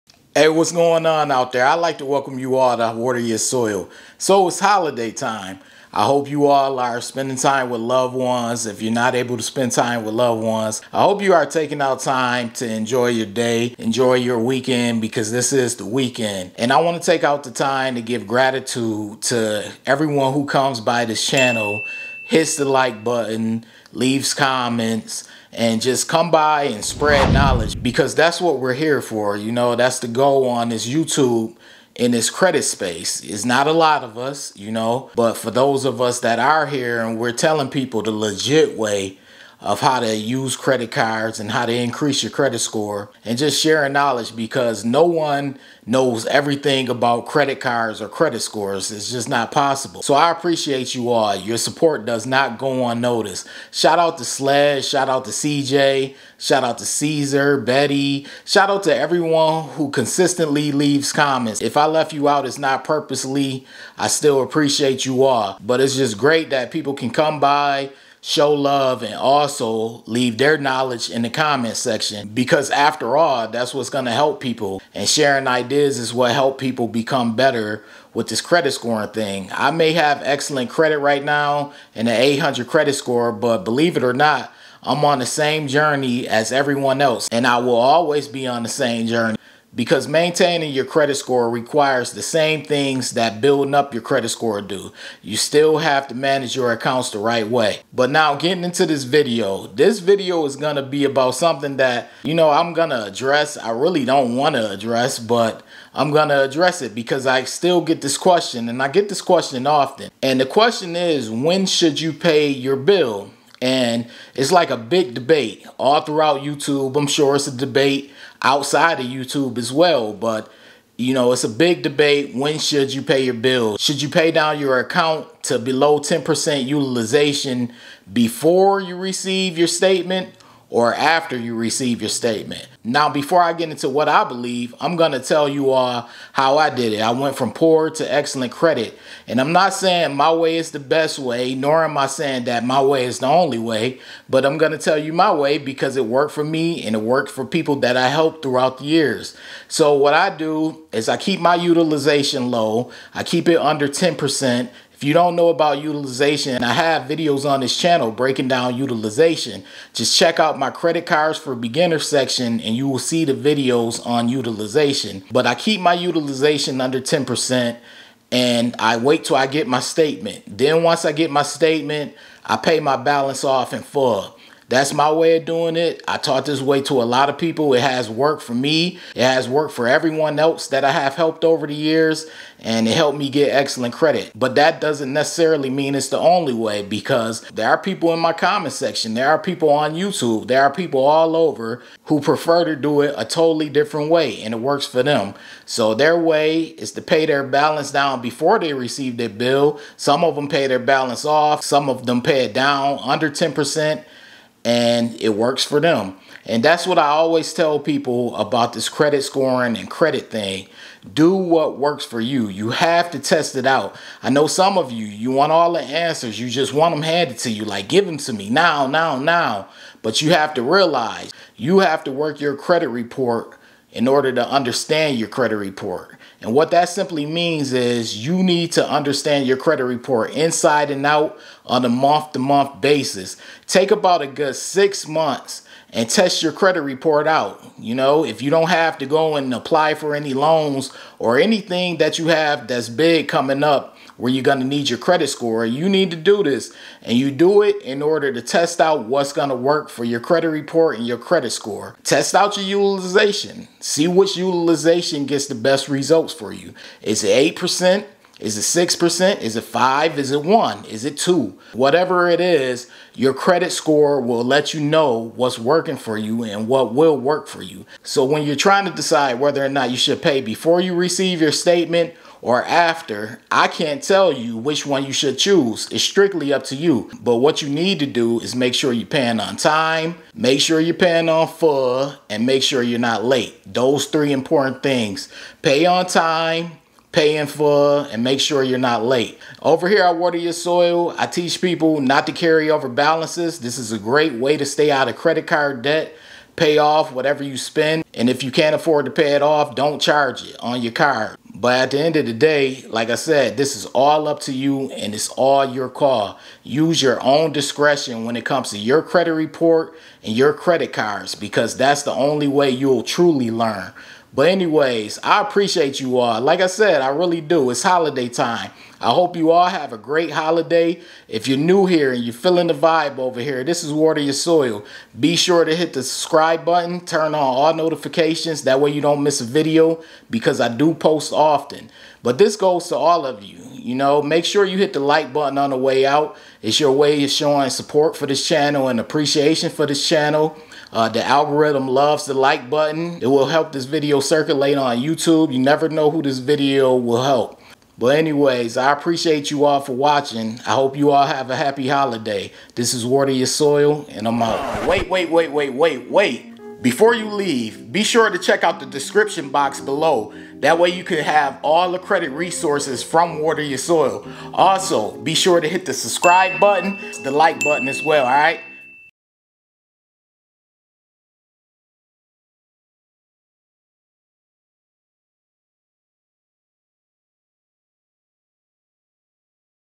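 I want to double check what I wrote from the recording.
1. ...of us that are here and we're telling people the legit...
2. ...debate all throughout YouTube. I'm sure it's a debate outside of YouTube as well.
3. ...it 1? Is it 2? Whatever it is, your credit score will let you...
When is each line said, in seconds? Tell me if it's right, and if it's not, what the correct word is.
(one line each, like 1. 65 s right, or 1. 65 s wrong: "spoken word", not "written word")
1. 35 s right
2. 115 s right
3. 260 s right.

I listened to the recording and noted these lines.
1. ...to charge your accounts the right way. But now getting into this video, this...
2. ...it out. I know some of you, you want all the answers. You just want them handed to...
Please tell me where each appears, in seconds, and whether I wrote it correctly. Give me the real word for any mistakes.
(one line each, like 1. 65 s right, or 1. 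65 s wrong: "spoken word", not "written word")
1. 96 s wrong: "manage", not "charge"
2. 213 s right.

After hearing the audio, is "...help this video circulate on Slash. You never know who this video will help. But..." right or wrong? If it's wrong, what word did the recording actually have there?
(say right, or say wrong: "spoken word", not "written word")
wrong: "YouTube", not "Slash".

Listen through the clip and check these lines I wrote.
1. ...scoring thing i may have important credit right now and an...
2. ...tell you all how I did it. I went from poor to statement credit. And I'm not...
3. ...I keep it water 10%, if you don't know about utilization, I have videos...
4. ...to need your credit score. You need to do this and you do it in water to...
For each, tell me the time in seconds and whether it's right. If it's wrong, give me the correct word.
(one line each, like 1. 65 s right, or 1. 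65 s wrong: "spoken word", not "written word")
1. 78 s wrong: "excellent", not "important"
2. 135 s wrong: "excellent", not "statement"
3. 153 s wrong: "under", not "water"
4. 244 s wrong: "order", not "water".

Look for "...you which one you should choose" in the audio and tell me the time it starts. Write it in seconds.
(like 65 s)
274 s.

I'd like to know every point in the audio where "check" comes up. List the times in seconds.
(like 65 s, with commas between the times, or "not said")
160 s, 358 s.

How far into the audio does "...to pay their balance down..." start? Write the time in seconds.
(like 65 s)
196 s.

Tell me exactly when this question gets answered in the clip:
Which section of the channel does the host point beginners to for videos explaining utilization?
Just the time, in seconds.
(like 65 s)
160 s.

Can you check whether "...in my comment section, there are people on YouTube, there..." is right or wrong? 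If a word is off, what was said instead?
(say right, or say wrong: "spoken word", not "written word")
right.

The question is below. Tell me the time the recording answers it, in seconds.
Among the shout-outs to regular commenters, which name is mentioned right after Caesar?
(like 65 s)
57 s.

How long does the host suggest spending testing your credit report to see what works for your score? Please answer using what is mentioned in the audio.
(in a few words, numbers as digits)
6 months.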